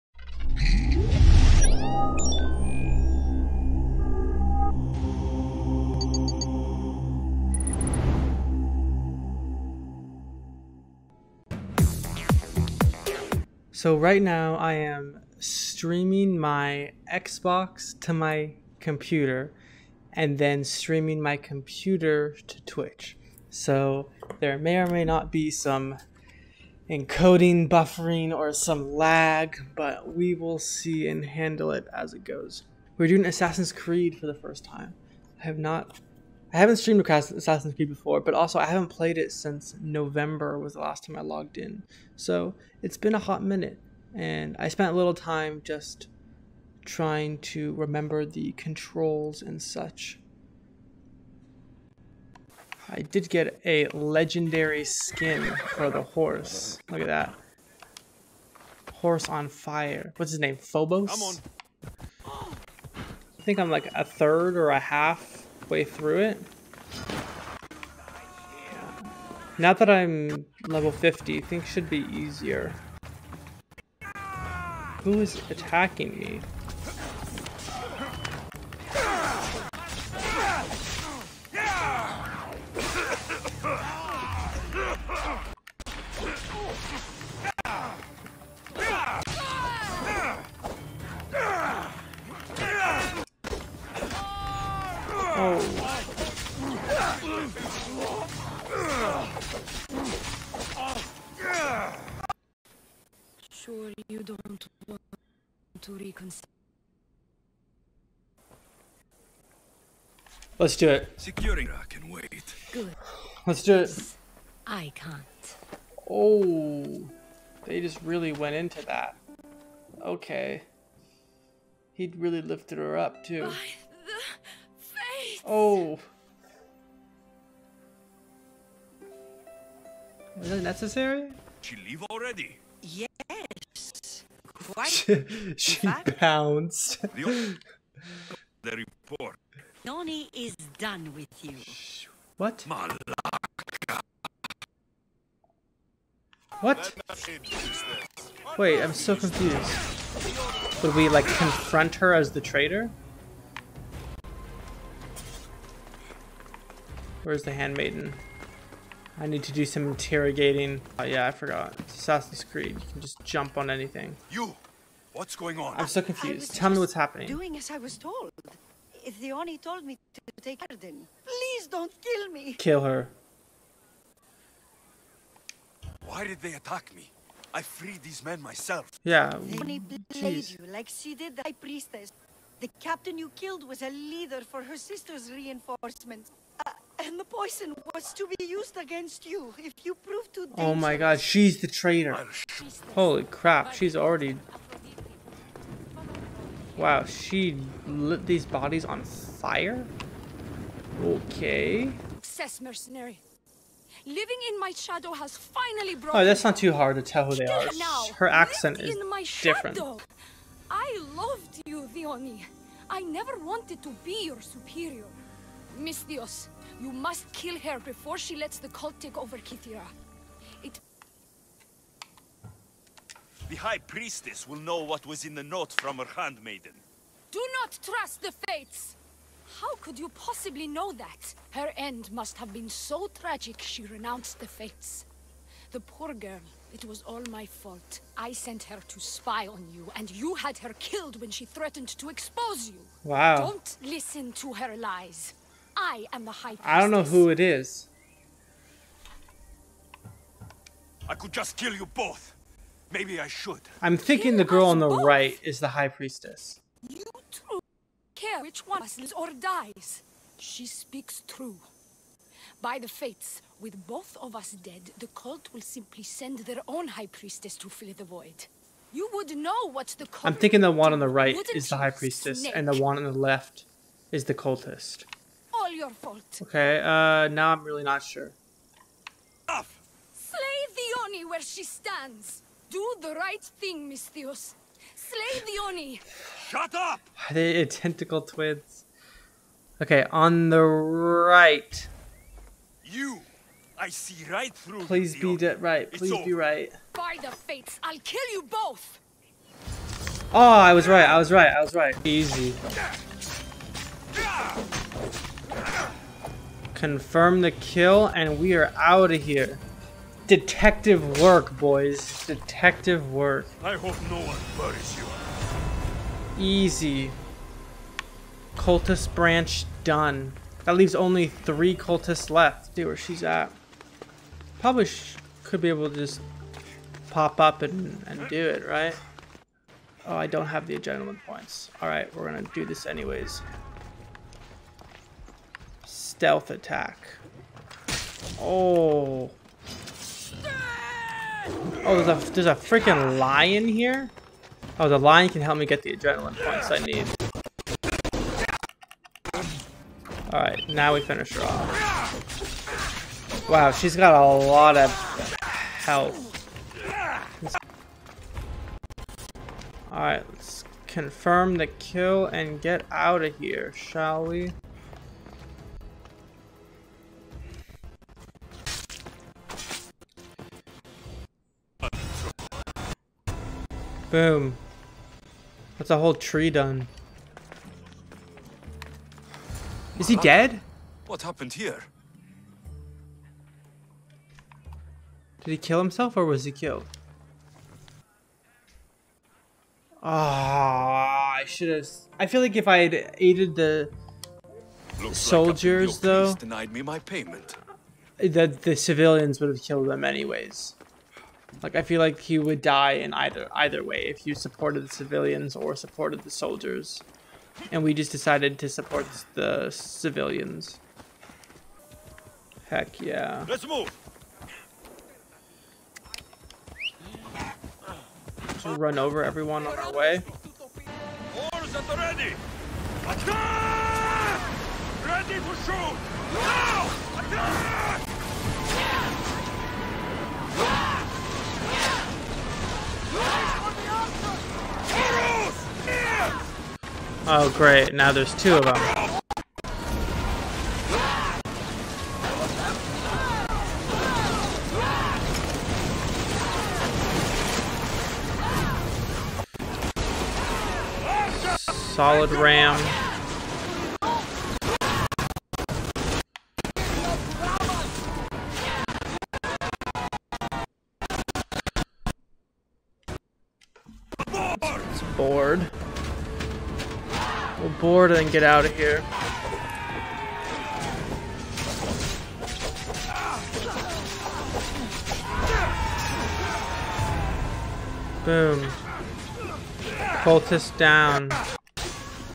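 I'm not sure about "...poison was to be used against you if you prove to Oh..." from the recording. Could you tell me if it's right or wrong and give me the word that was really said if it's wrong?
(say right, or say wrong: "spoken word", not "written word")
right.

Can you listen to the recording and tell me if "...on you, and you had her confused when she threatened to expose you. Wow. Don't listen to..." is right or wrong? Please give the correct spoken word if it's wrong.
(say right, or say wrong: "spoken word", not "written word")
wrong: "killed", not "confused".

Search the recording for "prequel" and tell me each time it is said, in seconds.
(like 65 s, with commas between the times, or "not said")
not said.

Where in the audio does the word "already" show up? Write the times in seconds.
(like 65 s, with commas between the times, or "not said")
132 s, 193 s.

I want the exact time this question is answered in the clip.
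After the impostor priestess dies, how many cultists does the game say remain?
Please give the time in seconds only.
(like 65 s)
321 s.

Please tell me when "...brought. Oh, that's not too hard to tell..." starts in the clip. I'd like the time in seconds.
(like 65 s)
205 s.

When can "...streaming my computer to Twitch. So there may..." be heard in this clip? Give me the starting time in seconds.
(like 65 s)
20 s.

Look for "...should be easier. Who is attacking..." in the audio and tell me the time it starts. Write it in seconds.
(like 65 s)
71 s.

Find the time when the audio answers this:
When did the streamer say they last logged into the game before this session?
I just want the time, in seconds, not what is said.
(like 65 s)
39 s.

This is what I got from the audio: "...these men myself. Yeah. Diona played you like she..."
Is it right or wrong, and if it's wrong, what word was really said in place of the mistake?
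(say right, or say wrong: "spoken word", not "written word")
right.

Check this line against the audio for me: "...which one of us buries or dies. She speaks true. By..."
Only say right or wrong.
wrong.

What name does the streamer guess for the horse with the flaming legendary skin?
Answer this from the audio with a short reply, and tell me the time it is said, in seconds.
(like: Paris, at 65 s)
Phobos, at 60 s.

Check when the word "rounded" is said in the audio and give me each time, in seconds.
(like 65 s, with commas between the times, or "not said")
not said.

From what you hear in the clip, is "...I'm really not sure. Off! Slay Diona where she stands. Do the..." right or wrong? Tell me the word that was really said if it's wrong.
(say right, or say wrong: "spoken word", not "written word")
right.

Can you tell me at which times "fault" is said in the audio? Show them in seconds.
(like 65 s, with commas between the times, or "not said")
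237 s, 275 s.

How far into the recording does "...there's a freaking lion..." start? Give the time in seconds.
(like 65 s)
342 s.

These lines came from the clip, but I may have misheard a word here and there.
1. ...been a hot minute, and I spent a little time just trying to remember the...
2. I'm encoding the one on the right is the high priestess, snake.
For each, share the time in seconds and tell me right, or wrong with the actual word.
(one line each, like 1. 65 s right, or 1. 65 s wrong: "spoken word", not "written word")
1. 42 s right
2. 270 s wrong: "thinking", not "encoding".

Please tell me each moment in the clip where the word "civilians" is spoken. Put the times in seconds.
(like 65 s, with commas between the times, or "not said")
398 s, 404 s, 409 s.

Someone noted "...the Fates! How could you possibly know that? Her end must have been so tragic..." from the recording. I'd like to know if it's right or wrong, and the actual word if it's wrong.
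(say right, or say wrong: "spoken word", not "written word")
right.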